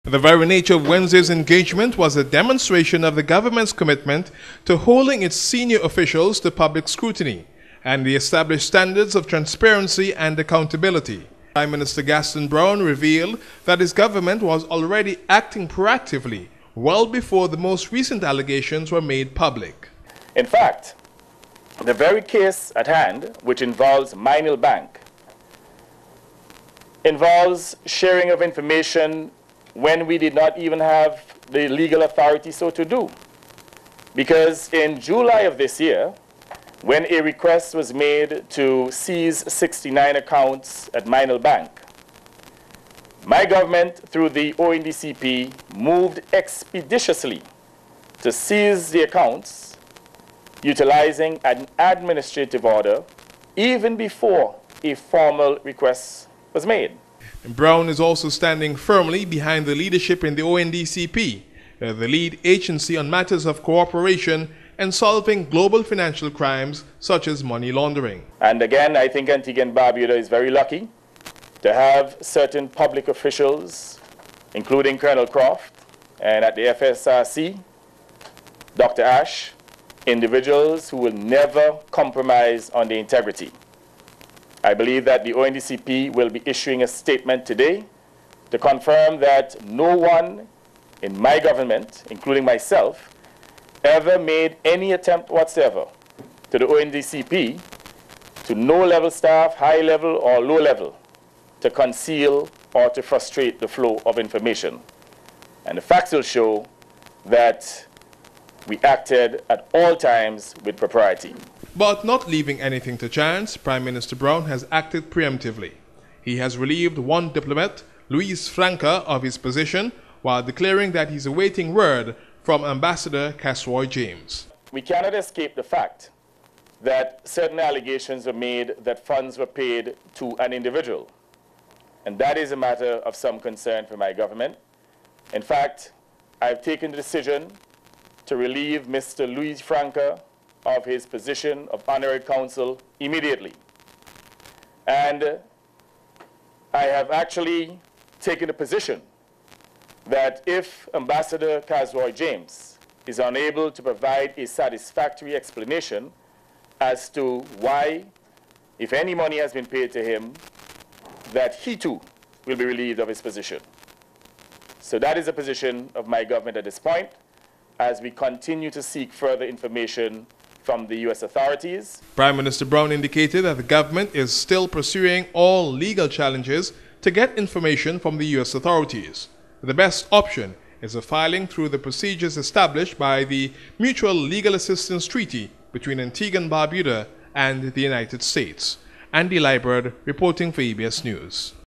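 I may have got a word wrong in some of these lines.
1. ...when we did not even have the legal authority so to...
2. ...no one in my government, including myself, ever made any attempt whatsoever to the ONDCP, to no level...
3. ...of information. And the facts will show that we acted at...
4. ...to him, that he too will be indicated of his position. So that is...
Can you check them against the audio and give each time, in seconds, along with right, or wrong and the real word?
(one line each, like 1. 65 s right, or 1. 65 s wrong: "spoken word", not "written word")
1. 29 s right
2. 89 s right
3. 104 s right
4. 159 s wrong: "relieved", not "indicated".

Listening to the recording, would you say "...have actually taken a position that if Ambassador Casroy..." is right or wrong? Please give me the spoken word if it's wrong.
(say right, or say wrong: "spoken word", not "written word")
right.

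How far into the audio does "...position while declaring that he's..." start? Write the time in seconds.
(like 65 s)
119 s.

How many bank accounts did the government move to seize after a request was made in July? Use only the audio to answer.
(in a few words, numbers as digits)
69.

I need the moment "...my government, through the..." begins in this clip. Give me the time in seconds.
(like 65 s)
43 s.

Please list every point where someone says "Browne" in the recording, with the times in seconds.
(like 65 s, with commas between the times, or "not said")
12 s, 57 s, 114 s, 172 s.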